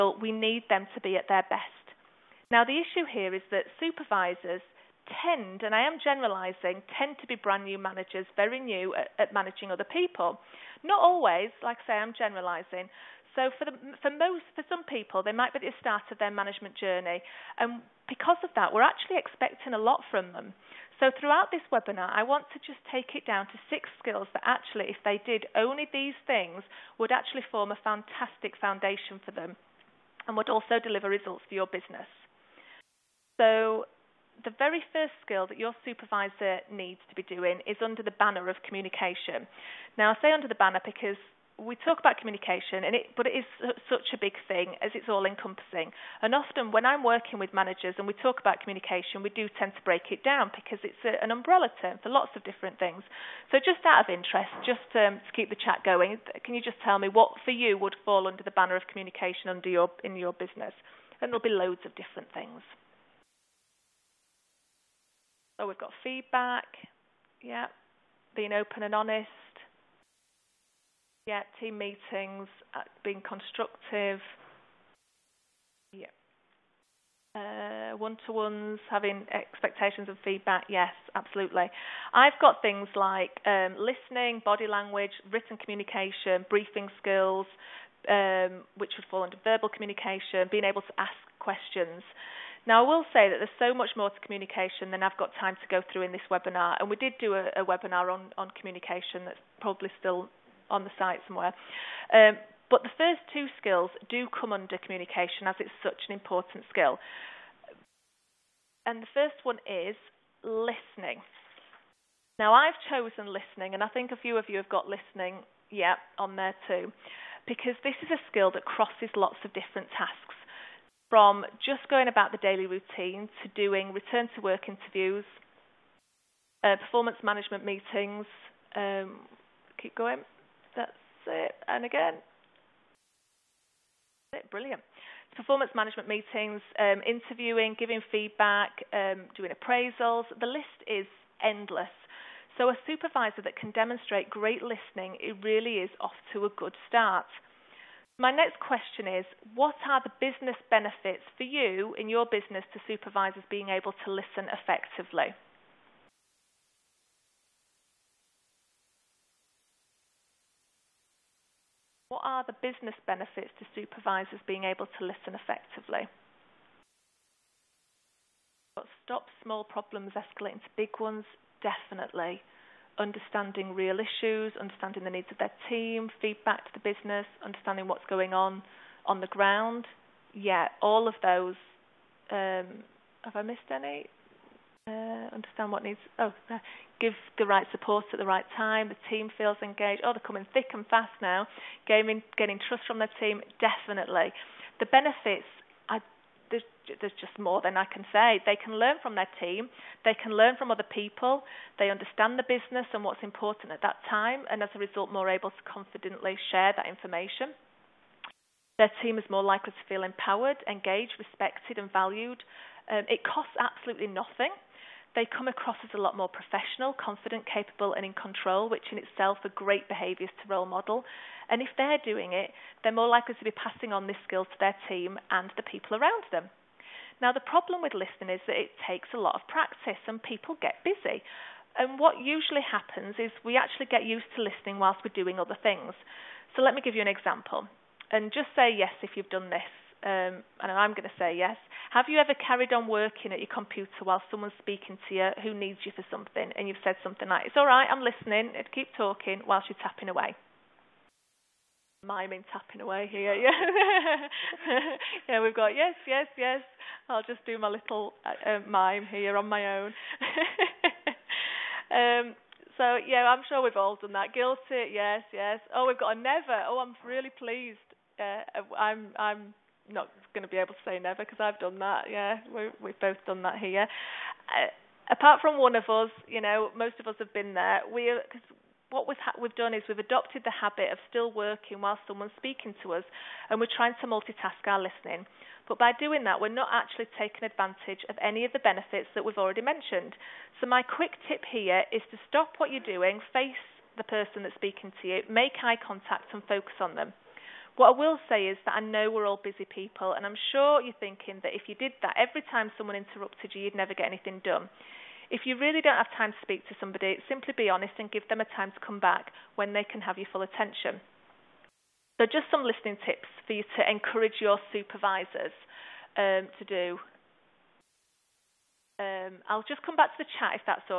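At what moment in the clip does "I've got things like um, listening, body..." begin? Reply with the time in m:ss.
1:22.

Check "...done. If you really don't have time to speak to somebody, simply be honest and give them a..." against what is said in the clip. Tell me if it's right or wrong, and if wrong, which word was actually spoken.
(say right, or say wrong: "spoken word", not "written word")
right.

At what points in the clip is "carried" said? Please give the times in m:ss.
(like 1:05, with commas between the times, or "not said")
4:02.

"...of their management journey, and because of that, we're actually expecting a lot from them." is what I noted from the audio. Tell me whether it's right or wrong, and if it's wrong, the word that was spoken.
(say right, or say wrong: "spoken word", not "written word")
right.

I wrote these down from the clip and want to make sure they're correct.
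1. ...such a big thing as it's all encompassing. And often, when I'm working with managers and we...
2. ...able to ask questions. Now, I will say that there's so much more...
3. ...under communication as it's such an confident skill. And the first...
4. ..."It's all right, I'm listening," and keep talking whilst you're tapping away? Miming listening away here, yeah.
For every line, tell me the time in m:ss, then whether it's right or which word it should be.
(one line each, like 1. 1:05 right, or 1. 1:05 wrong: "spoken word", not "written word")
1. 0:43 right
2. 1:30 right
3. 1:44 wrong: "important", not "confident"
4. 4:07 wrong: "tapping", not "listening".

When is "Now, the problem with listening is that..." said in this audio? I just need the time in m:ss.
3:47.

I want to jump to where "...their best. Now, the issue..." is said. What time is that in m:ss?
0:01.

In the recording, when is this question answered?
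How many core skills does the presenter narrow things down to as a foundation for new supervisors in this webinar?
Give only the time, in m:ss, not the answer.
0:23.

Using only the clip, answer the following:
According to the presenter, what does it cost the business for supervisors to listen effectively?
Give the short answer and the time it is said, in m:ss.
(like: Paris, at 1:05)
absolutely nothing, at 3:33.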